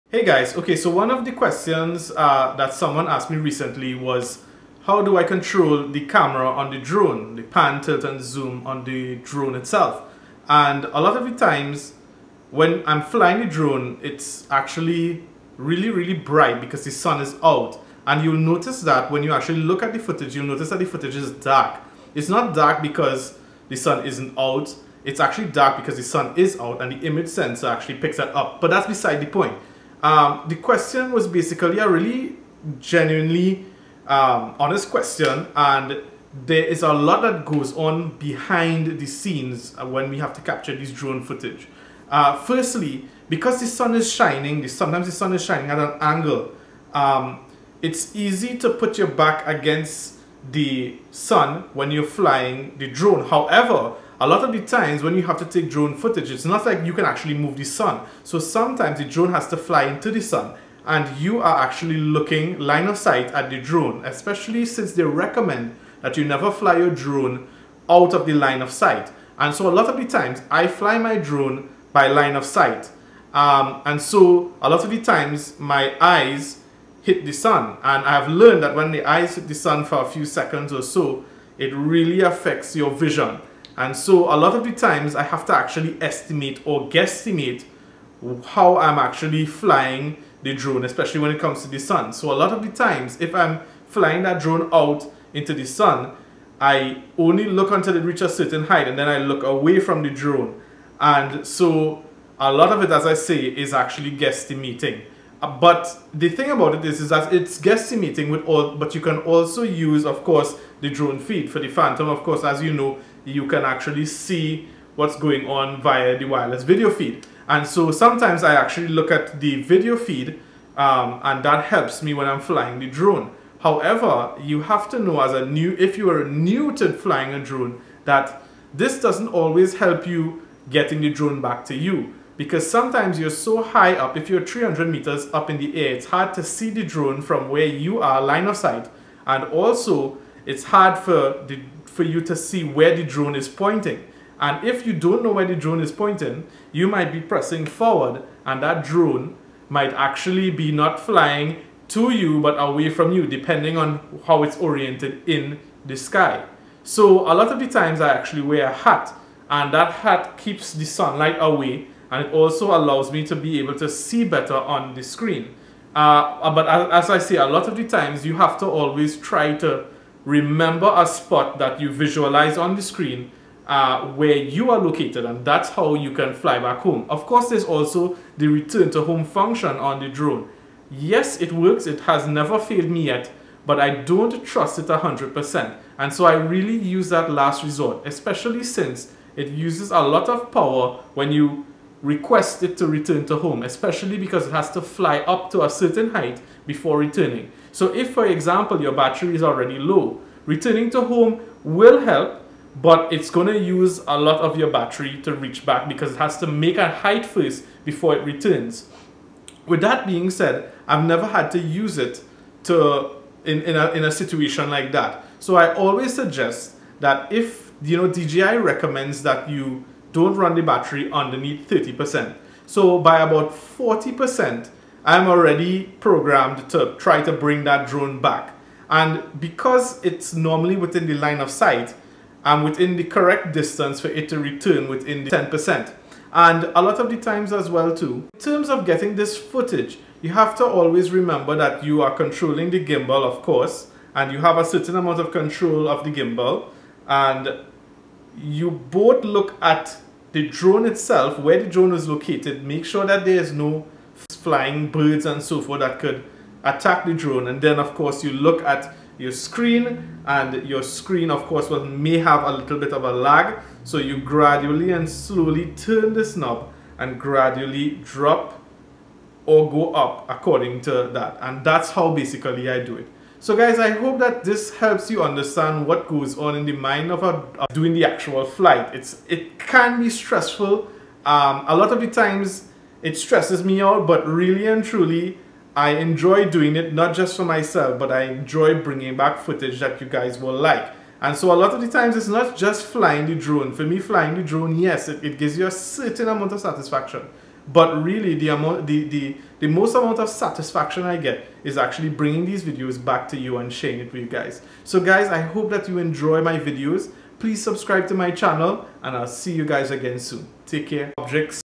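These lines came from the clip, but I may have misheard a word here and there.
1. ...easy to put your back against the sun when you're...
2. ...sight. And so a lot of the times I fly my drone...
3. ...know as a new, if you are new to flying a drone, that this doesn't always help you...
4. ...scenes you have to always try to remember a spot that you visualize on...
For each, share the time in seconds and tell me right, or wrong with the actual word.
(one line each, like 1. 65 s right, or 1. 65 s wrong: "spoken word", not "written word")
1. 48 s right
2. 68 s right
3. 124 s right
4. 167 s wrong: "times", not "scenes".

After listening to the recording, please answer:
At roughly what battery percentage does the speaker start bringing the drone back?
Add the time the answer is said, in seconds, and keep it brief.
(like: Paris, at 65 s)
40%, at 223 s.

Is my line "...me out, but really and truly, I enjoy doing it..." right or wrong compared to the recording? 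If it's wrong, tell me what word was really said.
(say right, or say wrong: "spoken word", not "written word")
right.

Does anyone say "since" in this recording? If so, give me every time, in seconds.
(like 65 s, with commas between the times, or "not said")
64 s, 188 s.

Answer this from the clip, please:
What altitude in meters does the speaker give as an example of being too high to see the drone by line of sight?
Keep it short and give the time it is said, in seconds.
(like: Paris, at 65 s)
300 meters, at 134 s.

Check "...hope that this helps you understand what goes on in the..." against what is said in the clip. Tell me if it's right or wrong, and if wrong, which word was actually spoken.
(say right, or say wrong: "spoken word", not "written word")
right.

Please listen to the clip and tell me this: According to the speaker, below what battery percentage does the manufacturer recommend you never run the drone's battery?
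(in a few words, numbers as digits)
30%.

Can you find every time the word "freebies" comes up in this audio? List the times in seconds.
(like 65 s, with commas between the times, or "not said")
not said.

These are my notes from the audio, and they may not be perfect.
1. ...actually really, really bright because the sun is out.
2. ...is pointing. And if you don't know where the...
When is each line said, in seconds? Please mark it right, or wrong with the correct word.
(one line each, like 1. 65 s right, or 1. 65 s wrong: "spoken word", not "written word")
1. 14 s right
2. 143 s right.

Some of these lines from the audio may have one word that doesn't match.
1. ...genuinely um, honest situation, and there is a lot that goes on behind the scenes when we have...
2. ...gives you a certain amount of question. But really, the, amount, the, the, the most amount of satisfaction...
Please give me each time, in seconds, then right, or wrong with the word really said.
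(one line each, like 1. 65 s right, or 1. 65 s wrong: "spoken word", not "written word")
1. 32 s wrong: "question", not "situation"
2. 295 s wrong: "satisfaction", not "question".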